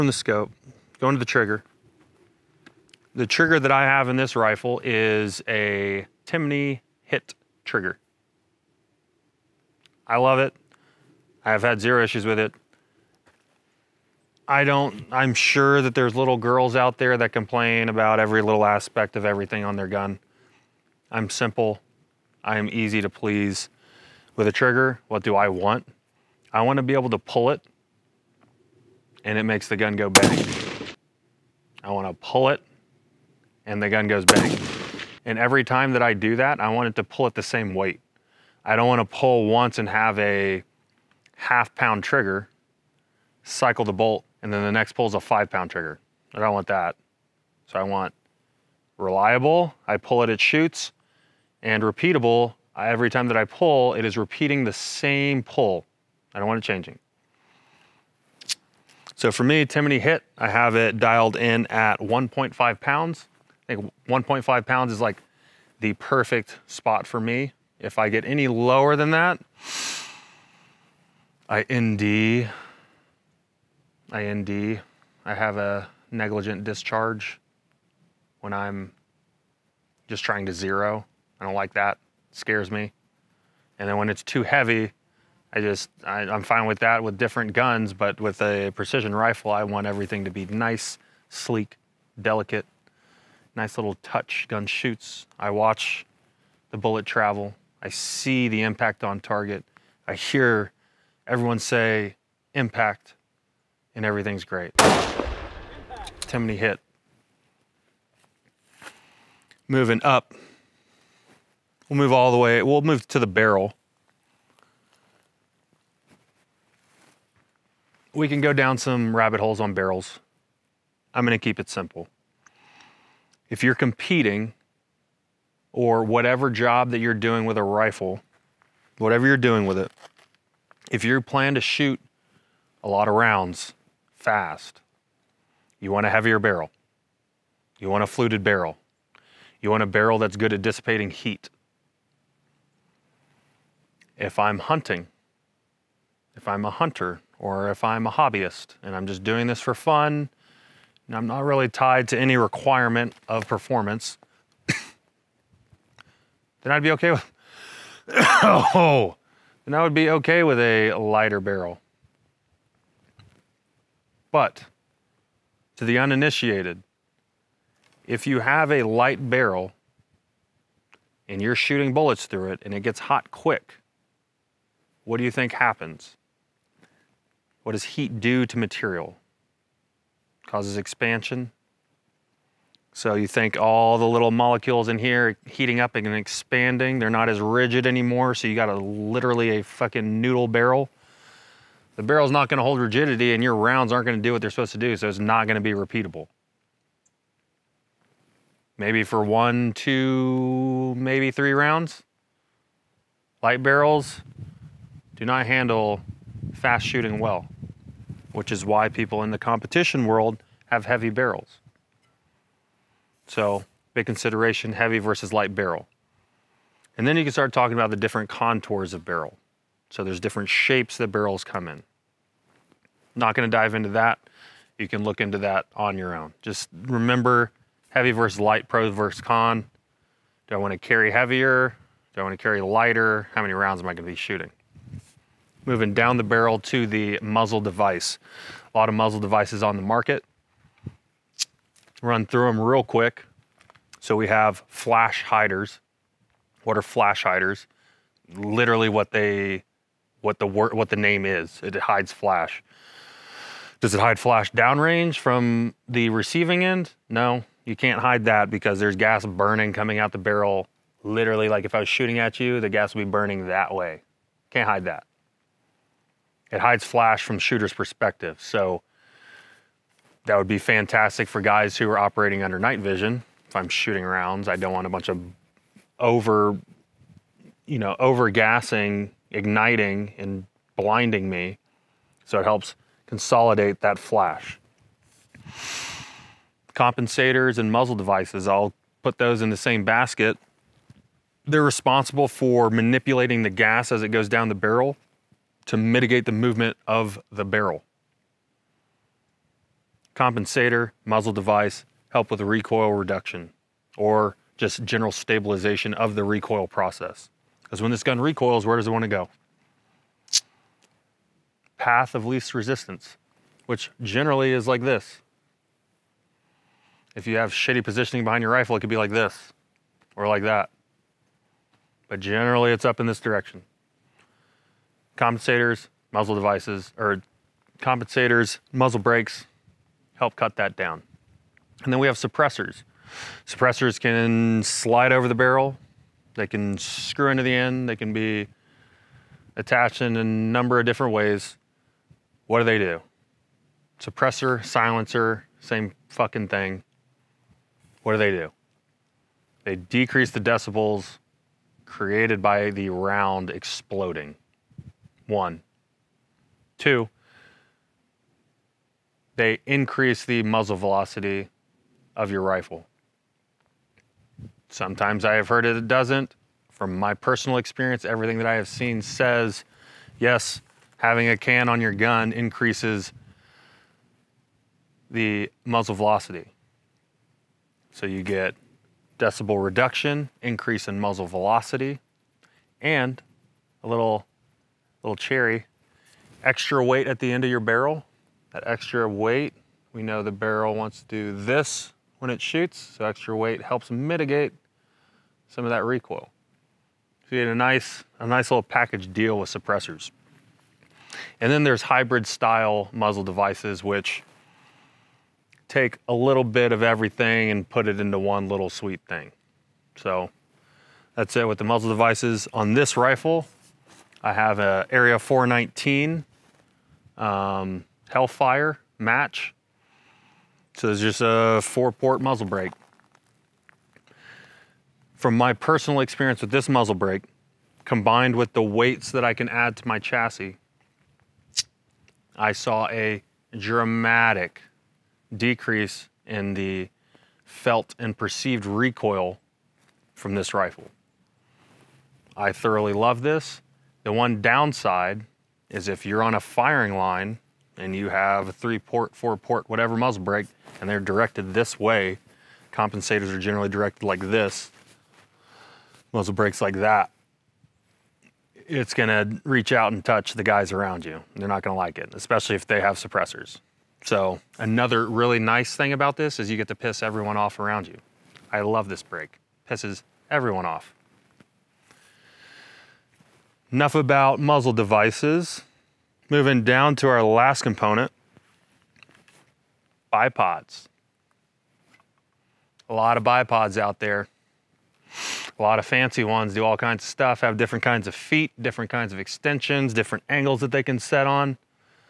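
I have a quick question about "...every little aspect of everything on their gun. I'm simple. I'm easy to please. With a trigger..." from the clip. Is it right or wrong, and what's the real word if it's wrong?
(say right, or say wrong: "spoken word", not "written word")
right.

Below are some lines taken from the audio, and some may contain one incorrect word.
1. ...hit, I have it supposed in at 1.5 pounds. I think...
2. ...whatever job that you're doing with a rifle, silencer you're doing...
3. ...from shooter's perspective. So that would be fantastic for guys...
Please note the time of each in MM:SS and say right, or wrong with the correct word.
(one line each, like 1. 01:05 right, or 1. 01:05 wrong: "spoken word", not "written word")
1. 00:59 wrong: "dialed", not "supposed"
2. 02:06 wrong: "whatever", not "silencer"
3. 04:27 right.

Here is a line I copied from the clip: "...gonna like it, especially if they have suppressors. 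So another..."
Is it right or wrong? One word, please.
right.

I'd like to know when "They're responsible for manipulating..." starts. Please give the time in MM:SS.
04:51.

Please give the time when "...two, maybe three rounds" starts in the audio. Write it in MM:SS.
03:19.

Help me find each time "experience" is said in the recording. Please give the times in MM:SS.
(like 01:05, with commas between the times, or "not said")
06:07, 07:05.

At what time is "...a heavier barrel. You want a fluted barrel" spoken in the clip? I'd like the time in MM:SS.
02:16.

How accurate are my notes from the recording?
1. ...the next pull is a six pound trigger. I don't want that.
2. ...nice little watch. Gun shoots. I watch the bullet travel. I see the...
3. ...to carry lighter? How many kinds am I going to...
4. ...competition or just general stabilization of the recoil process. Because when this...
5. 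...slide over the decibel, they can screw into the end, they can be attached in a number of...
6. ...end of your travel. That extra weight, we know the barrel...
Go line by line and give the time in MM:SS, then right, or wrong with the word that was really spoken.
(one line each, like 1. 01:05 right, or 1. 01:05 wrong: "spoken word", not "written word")
1. 00:44 wrong: "five", not "six"
2. 01:33 wrong: "touch", not "watch"
3. 03:52 wrong: "rounds", not "kinds"
4. 05:02 wrong: "reduction", not "competition"
5. 05:34 wrong: "barrel", not "decibel"
6. 06:27 wrong: "barrel", not "travel".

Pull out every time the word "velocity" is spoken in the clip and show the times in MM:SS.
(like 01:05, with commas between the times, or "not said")
06:00, 06:15, 06:21.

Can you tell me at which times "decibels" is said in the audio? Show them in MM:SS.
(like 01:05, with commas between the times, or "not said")
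05:50, 06:19.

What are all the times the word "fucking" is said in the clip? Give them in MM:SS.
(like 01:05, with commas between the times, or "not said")
03:09, 05:46.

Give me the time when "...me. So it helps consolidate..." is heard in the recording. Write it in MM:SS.
04:41.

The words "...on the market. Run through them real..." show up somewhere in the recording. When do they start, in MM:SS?
03:59.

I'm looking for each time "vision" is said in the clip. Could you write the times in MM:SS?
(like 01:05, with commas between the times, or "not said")
04:32.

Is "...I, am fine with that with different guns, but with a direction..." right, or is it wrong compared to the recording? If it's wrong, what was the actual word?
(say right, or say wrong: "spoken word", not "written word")
wrong: "precision", not "direction".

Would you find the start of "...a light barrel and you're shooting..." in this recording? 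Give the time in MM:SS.
02:48.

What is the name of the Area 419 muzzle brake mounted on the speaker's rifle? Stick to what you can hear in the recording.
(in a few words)
Hellfire Match.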